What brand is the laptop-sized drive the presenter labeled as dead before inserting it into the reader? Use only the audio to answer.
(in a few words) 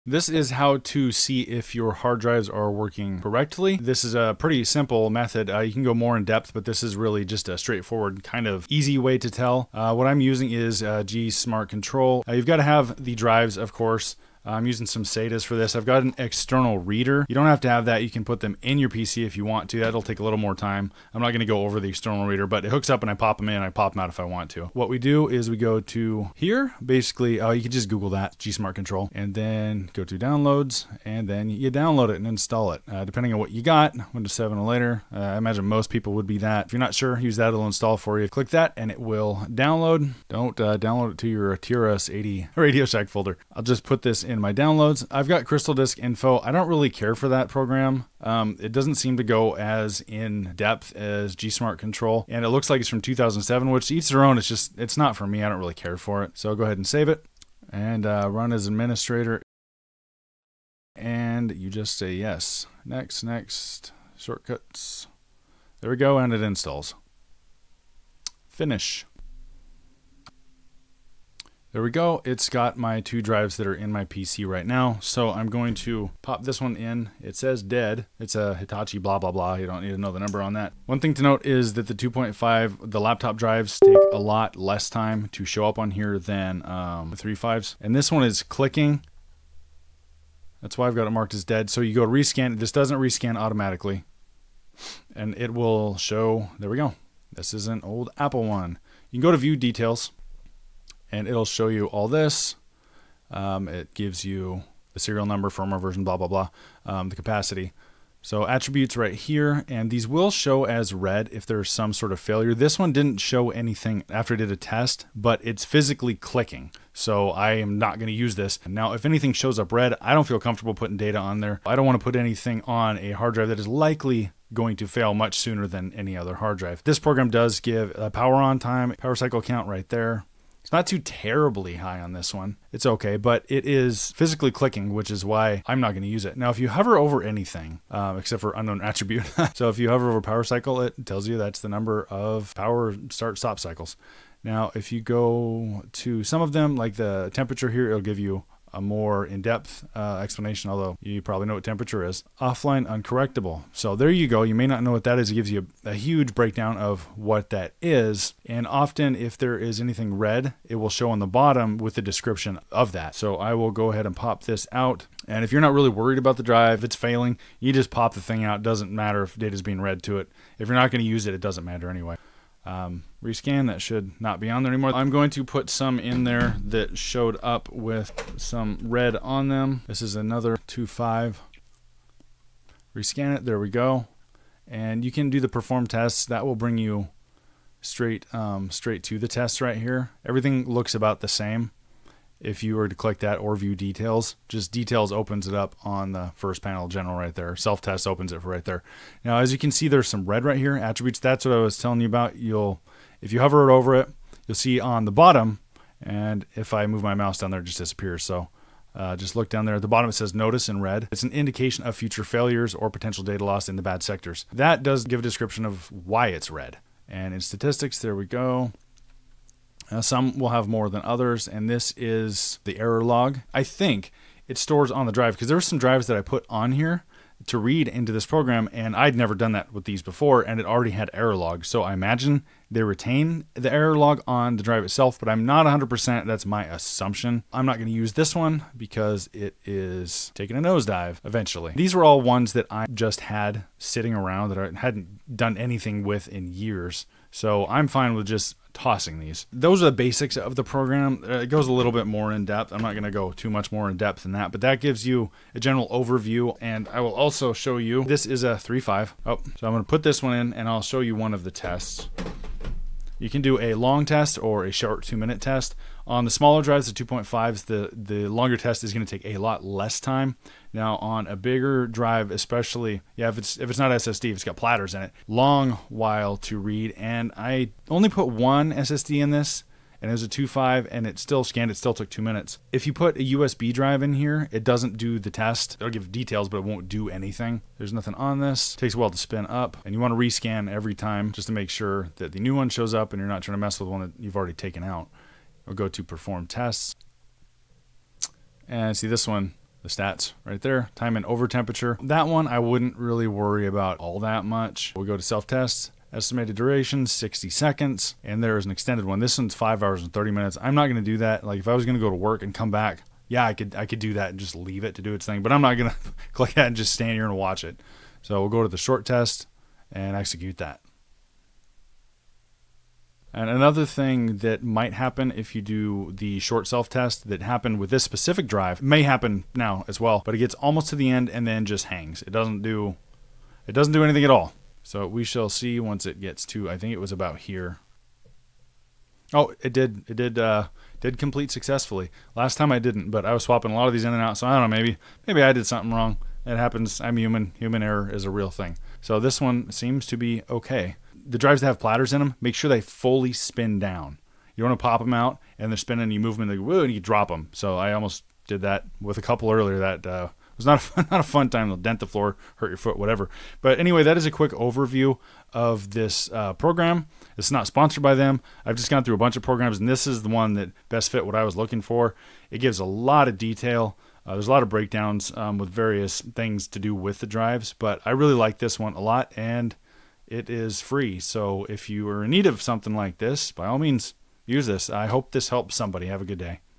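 Hitachi.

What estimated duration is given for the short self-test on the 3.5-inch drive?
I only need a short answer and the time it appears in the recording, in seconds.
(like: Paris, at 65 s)
60 seconds, at 307 s.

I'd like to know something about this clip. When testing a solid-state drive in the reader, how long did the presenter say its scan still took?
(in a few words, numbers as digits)
2 minutes.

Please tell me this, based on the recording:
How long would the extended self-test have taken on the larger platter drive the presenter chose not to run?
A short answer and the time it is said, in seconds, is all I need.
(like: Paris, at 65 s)
5 hours 30 minutes, at 309 s.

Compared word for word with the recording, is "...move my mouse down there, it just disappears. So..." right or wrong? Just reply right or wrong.
right.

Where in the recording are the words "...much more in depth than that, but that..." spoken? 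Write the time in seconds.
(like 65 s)
253 s.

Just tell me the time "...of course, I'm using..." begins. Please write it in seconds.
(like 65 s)
13 s.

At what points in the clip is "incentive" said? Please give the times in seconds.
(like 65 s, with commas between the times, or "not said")
not said.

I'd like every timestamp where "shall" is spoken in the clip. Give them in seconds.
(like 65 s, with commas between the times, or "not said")
335 s.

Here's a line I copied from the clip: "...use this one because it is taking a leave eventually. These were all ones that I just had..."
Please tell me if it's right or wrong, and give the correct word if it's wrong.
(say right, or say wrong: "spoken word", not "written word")
wrong: "nosedive", not "leave".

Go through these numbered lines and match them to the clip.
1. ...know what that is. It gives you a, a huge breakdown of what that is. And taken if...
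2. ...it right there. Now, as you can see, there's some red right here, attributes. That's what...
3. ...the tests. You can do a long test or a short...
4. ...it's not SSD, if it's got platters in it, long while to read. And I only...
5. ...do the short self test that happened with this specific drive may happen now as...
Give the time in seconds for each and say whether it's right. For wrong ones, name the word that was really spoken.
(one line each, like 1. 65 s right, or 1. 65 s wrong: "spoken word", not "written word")
1. 154 s wrong: "often", not "taken"
2. 198 s right
3. 261 s right
4. 273 s right
5. 325 s right.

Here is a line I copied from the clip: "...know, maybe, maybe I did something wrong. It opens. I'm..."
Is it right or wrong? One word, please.
wrong.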